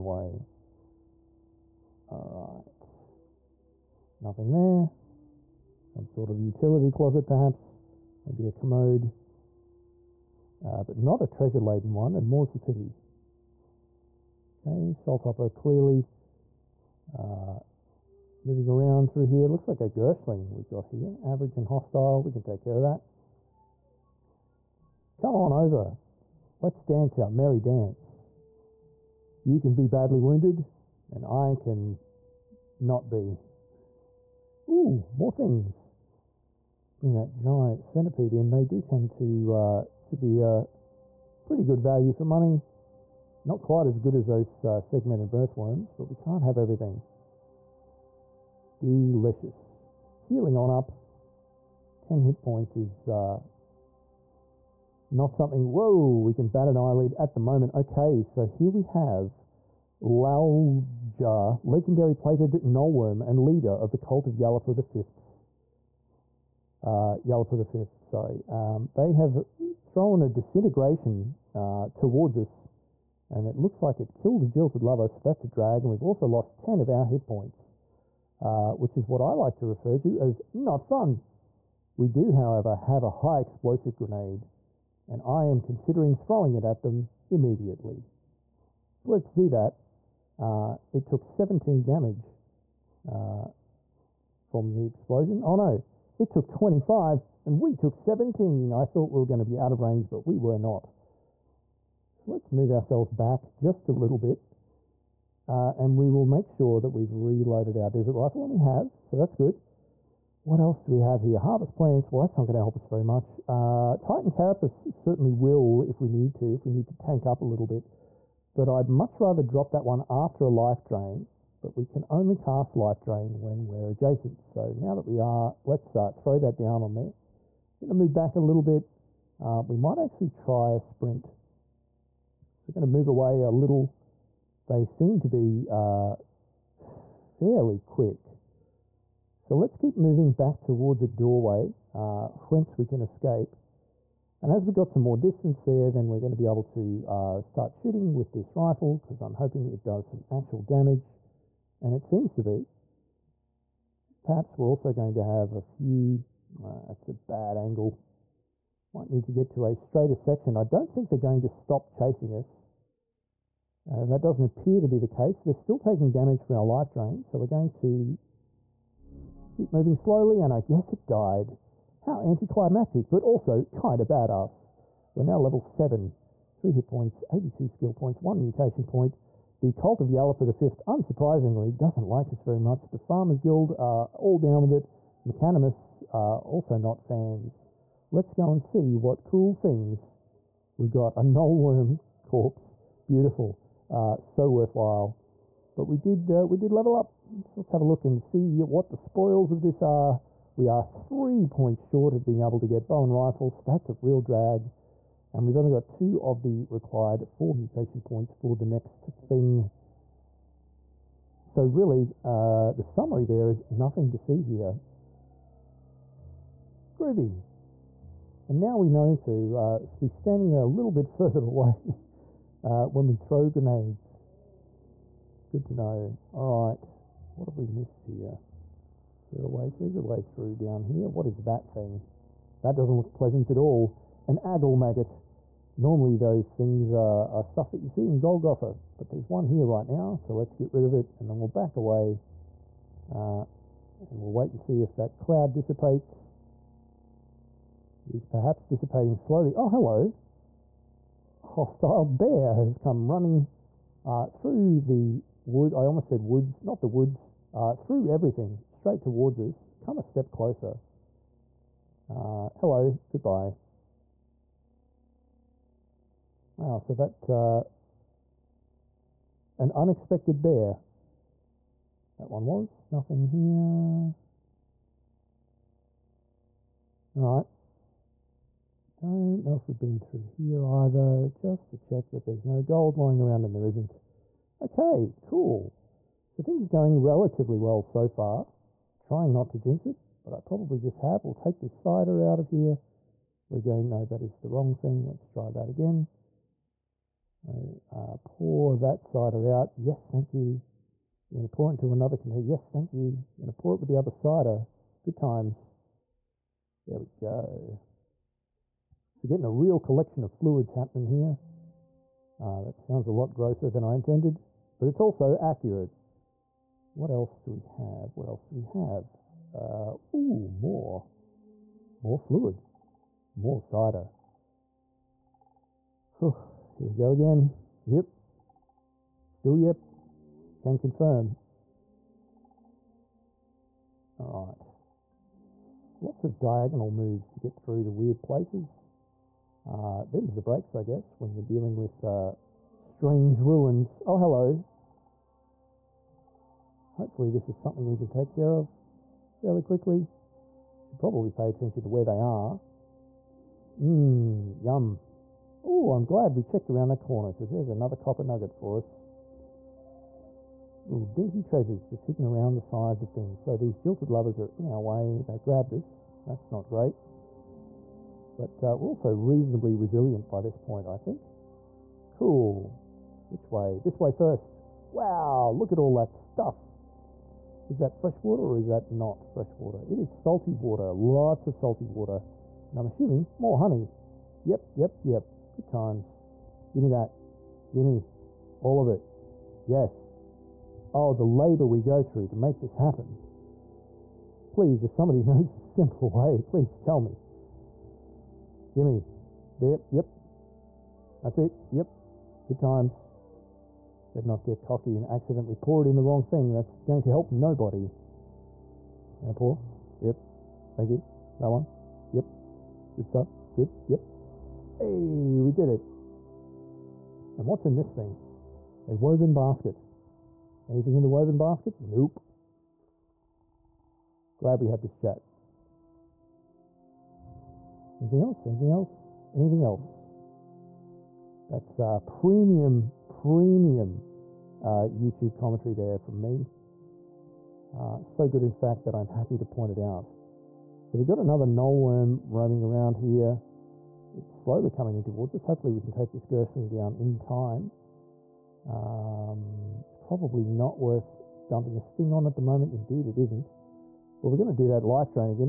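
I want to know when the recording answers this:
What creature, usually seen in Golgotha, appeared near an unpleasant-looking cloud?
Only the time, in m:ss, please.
3:54.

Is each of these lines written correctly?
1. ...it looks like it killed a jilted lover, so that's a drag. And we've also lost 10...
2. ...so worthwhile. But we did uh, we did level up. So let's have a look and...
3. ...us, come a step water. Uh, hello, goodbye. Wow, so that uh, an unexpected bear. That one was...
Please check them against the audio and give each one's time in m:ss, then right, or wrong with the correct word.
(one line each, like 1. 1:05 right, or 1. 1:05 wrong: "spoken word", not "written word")
1. 1:13 right
2. 3:14 right
3. 4:19 wrong: "closer", not "water".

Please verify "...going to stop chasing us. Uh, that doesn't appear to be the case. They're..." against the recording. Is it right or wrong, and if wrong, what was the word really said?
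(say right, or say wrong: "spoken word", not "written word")
right.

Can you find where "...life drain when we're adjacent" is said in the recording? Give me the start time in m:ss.
2:02.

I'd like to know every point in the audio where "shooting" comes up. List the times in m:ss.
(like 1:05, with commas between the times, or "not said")
2:27.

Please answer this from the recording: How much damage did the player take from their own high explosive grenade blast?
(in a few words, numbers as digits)
17.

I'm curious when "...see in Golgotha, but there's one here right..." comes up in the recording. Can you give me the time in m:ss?
3:57.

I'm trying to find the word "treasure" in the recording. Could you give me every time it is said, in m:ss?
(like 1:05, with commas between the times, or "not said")
0:11, 6:01.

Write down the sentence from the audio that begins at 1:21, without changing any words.
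We do, however, have a high explosive grenade, and I am considering throwing it at them immediately.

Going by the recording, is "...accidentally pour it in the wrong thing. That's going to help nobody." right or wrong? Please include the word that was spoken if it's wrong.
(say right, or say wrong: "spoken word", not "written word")
right.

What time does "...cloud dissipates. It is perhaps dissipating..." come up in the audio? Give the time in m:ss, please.
4:05.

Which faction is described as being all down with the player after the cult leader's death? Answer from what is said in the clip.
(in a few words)
The Farmers Guild.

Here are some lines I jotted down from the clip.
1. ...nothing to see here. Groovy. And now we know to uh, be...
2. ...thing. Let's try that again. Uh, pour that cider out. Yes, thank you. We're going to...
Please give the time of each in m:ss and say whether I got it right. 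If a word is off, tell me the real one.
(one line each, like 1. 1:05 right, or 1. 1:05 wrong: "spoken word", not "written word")
1. 3:33 right
2. 4:54 right.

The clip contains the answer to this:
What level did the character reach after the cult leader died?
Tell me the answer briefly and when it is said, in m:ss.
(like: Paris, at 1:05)
7, at 2:55.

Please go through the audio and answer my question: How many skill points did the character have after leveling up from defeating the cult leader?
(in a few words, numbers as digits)
82.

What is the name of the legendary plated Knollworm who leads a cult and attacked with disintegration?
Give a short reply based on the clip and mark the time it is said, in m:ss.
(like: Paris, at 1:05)
Lalja, at 1:00.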